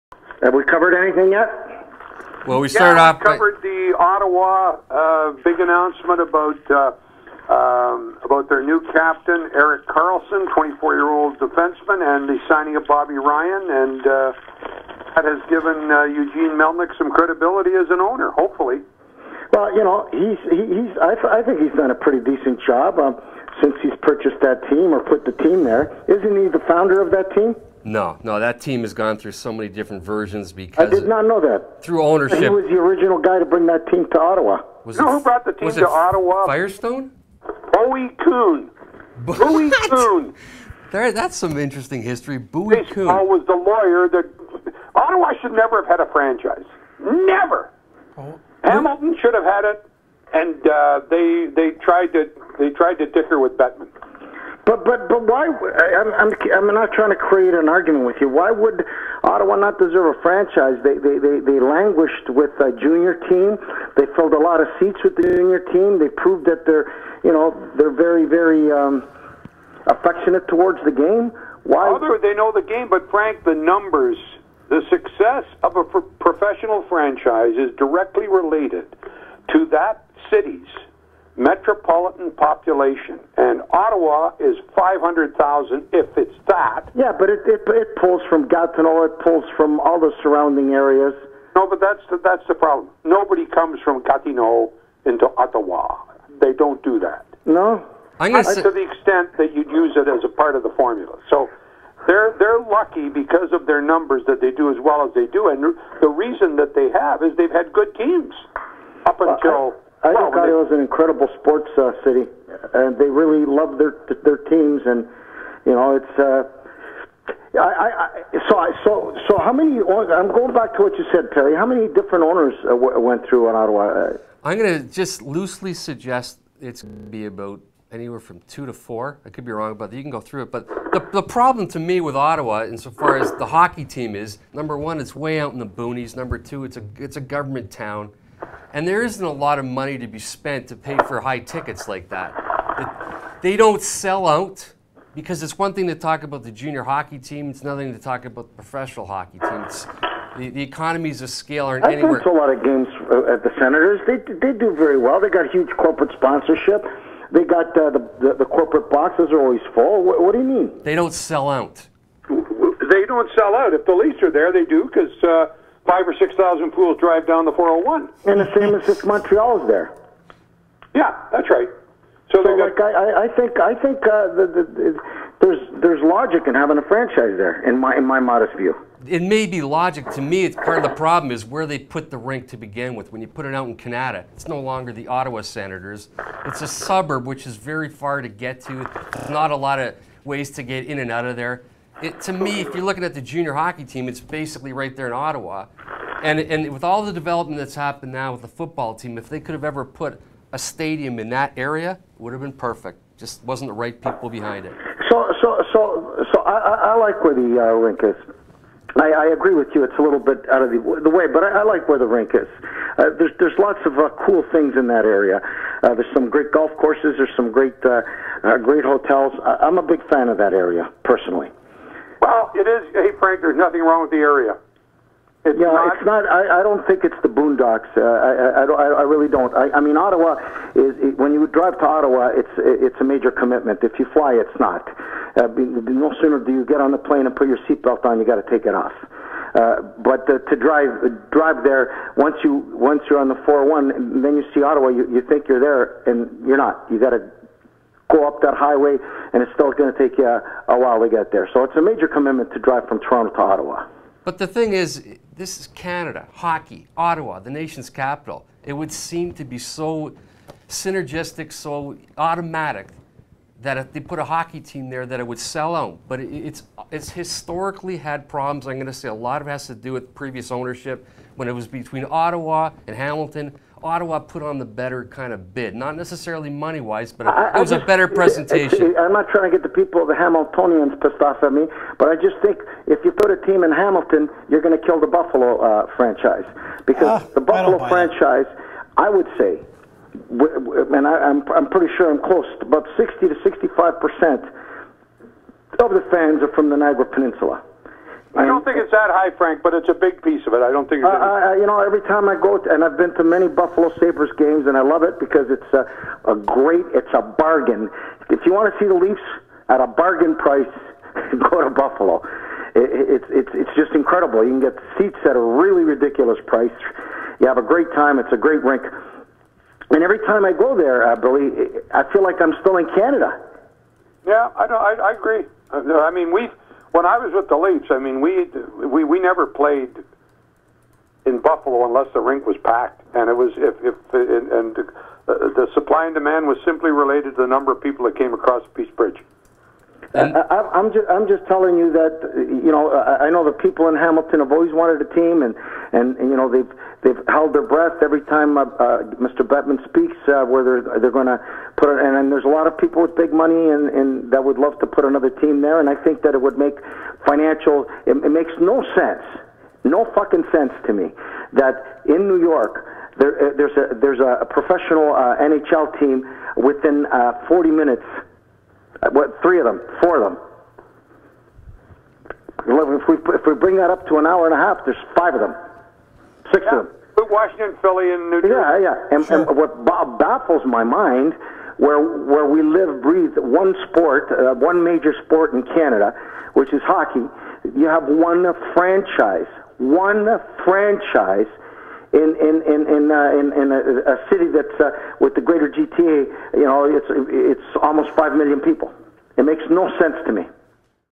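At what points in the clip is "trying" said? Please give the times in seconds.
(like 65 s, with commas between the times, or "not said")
56 s, 279 s.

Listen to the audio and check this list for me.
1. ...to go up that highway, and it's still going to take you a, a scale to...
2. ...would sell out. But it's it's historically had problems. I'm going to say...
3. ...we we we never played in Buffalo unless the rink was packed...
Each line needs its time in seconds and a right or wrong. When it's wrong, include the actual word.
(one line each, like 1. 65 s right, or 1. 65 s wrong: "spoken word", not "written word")
1. 247 s wrong: "while", not "scale"
2. 265 s right
3. 328 s right.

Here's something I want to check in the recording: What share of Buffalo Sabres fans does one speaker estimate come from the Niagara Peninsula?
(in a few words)
60 to 65 percent.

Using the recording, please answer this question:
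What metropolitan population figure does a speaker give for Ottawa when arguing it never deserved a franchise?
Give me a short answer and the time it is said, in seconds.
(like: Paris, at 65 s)
500,000, at 84 s.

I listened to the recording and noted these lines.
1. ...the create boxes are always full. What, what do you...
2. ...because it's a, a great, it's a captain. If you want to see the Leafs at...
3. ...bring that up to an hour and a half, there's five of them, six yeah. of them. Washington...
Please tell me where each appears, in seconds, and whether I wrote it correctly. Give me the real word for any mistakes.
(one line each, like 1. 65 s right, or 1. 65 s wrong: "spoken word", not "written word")
1. 158 s wrong: "corporate", not "create"
2. 305 s wrong: "bargain", not "captain"
3. 373 s right.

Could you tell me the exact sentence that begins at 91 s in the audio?
No, but that's the, that's the problem.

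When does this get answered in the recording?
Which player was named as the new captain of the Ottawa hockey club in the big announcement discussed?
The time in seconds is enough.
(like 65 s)
9 s.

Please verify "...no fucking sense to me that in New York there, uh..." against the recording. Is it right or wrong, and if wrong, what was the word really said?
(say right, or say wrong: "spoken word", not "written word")
right.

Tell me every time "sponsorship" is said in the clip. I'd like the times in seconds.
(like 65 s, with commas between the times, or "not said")
156 s.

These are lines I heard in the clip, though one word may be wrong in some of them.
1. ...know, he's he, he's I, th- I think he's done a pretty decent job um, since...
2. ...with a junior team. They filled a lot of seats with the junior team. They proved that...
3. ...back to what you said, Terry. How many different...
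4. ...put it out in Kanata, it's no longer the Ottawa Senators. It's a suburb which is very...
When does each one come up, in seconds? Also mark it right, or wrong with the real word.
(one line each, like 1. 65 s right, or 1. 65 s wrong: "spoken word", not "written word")
1. 19 s right
2. 62 s right
3. 120 s right
4. 183 s right.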